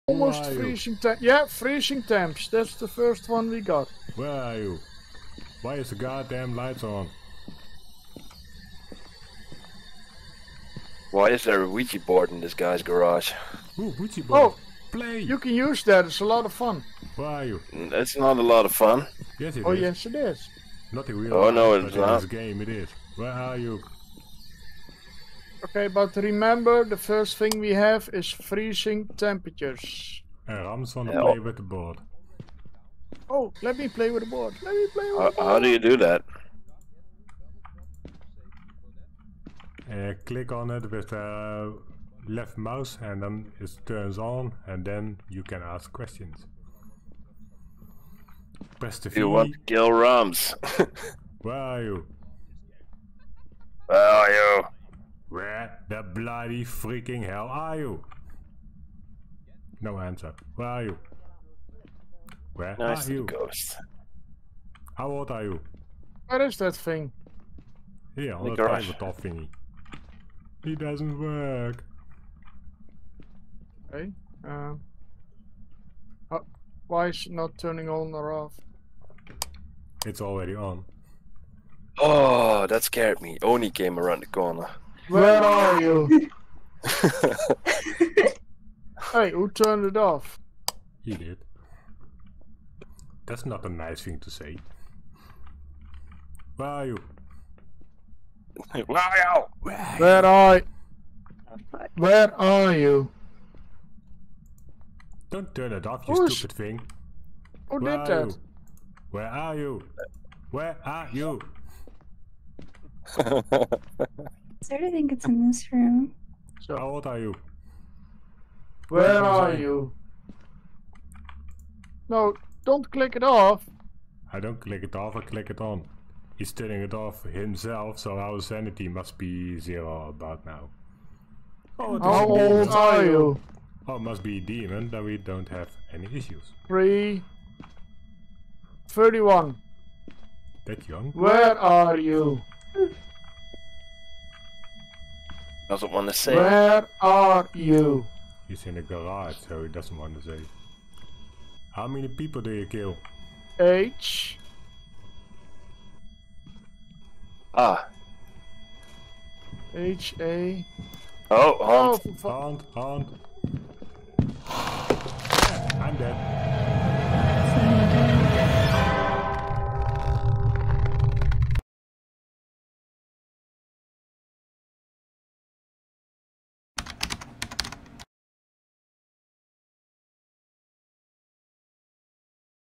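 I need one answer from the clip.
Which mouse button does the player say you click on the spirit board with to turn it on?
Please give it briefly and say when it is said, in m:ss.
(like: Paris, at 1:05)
Left, at 0:42.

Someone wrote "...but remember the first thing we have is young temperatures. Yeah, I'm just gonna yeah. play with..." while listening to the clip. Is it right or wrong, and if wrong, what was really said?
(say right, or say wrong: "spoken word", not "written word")
wrong: "freezing", not "young".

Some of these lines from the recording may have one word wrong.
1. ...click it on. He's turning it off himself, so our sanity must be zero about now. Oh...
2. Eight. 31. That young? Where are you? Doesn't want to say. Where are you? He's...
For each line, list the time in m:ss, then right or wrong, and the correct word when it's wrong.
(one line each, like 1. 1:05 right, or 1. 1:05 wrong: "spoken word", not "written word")
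1. 2:05 right
2. 2:16 wrong: "Three", not "Eight".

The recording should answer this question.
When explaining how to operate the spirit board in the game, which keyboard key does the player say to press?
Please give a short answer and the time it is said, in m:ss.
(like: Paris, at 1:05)
V, at 0:49.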